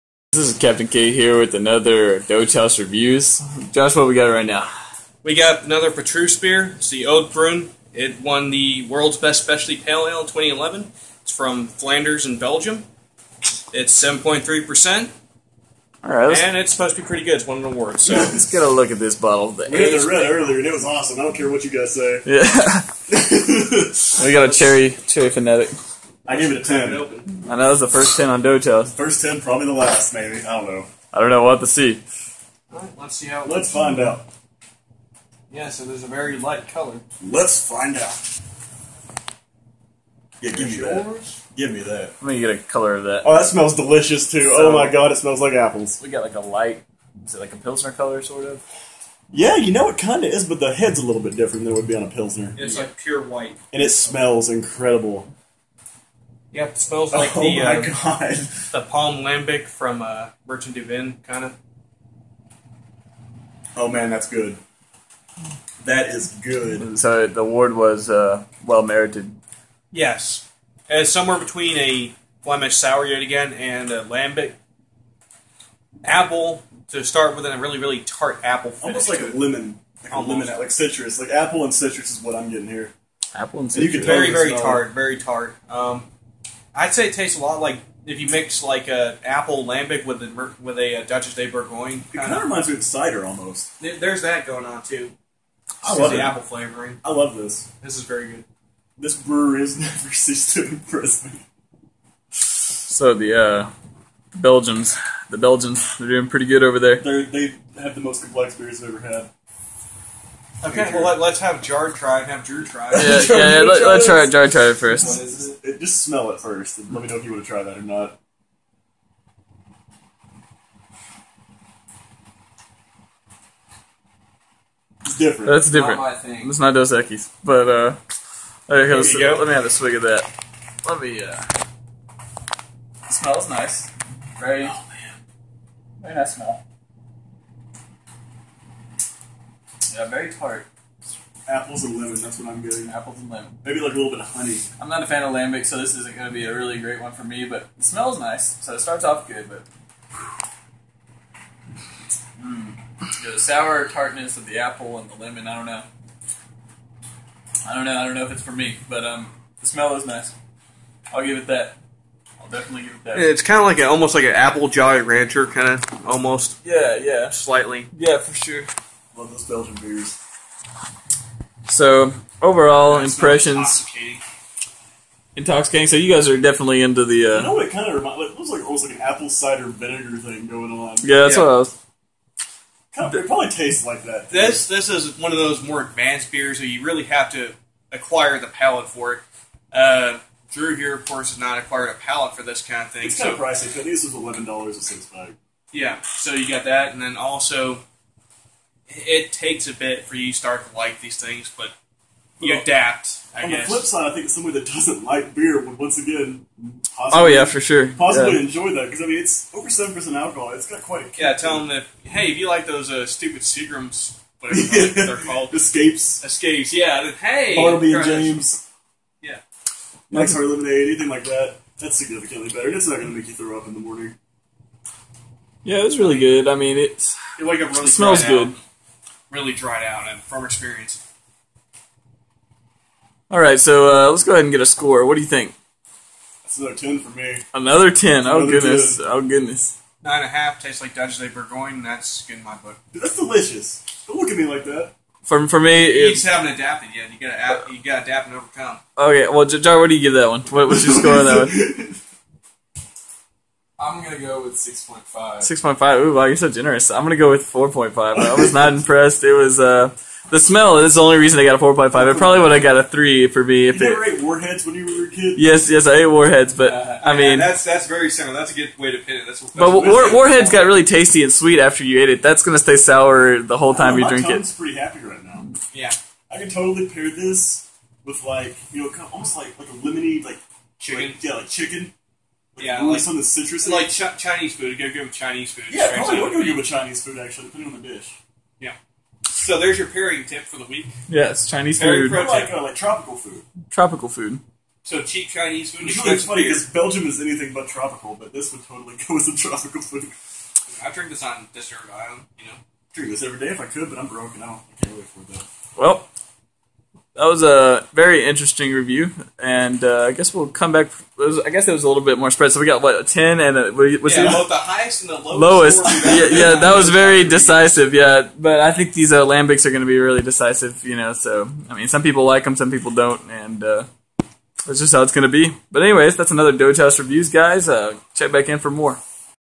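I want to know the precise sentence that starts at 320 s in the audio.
You know, so I mean, some people like them, some people don't, and uh, that's just how it's going to be.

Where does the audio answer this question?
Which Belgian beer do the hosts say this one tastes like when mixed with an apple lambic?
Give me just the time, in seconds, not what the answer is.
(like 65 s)
91 s.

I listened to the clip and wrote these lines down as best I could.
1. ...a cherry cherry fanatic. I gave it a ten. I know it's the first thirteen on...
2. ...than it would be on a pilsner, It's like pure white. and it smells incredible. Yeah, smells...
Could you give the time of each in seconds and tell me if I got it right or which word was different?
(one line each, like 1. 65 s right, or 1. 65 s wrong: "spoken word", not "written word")
1. 24 s wrong: "ten", not "thirteen"
2. 51 s right.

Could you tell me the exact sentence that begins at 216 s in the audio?
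Yeah, then, hey, Bartles and Jaymes.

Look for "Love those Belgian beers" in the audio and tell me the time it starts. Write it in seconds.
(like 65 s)
169 s.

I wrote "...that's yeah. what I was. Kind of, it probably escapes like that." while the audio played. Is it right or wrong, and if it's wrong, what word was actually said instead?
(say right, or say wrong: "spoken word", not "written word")
wrong: "tastes", not "escapes".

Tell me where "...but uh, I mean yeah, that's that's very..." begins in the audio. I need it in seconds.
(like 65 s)
266 s.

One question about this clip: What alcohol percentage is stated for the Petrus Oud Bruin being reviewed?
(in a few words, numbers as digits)
7.3%.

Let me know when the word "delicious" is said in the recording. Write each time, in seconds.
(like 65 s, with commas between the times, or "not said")
43 s, 243 s.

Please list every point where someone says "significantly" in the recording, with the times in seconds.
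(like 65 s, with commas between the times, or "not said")
221 s.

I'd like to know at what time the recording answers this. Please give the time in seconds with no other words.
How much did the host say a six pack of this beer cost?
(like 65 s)
194 s.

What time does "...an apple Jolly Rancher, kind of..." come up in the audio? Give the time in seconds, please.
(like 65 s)
164 s.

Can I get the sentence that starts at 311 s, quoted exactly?
Was, I guess it was a little bit more spread.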